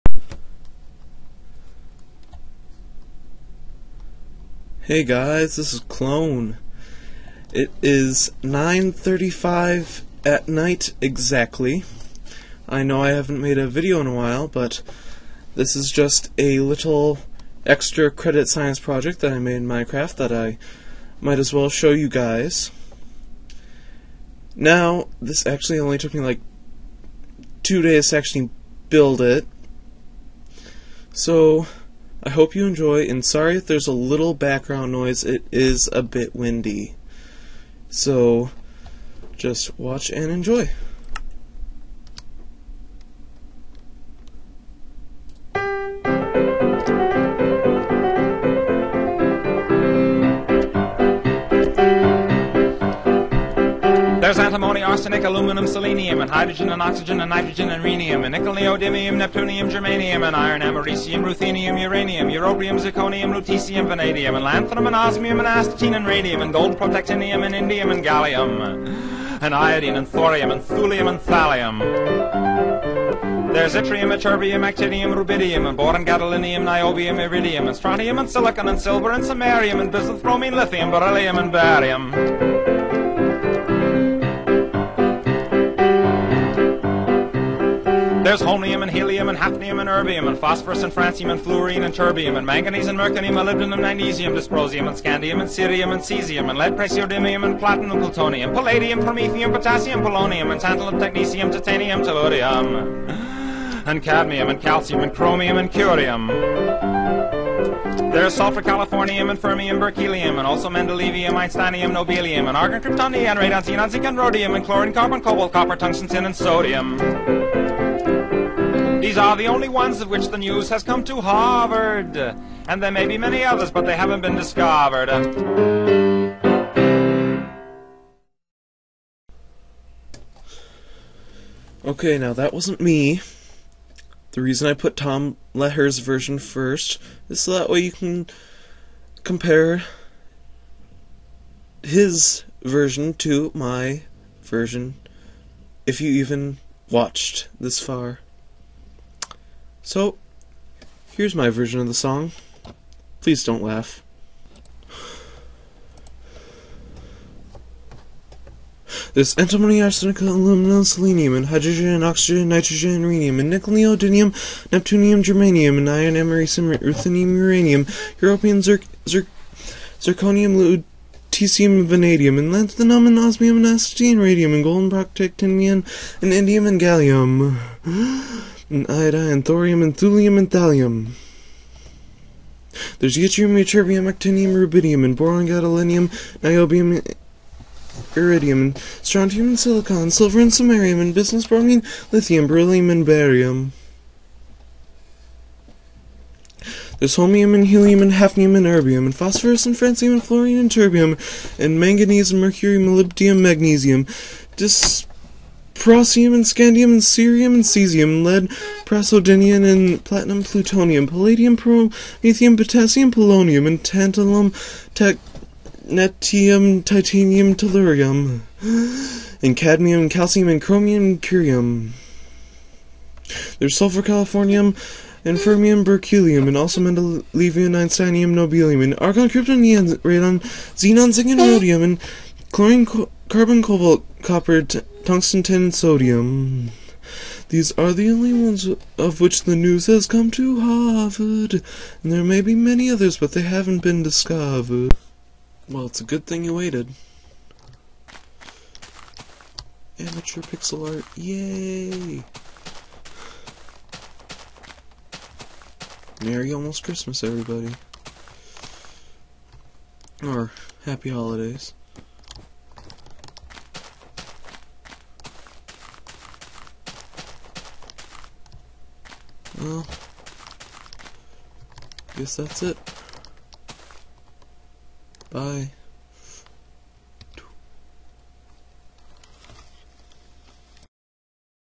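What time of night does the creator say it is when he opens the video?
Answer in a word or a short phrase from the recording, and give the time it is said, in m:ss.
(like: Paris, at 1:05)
9:35, at 0:08.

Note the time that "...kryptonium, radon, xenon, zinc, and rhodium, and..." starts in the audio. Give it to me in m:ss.
1:52.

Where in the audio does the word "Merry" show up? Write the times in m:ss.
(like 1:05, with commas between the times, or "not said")
4:16.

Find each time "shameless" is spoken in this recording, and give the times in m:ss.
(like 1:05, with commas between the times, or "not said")
not said.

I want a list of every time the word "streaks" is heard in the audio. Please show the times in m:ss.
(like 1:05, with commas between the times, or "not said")
not said.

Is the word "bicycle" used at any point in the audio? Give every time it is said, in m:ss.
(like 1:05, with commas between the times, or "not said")
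not said.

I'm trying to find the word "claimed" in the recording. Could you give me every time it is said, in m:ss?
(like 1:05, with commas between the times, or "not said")
not said.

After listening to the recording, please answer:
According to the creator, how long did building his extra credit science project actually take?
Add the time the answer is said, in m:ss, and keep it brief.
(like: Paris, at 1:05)
2 days, at 0:27.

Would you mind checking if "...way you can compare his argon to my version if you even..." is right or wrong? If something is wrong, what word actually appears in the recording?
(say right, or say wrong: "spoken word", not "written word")
wrong: "version", not "argon".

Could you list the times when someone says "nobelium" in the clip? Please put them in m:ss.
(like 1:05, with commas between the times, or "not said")
1:51, 3:48.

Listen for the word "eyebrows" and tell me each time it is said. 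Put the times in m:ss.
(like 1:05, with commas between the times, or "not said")
not said.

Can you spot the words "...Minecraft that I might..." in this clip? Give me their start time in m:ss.
0:19.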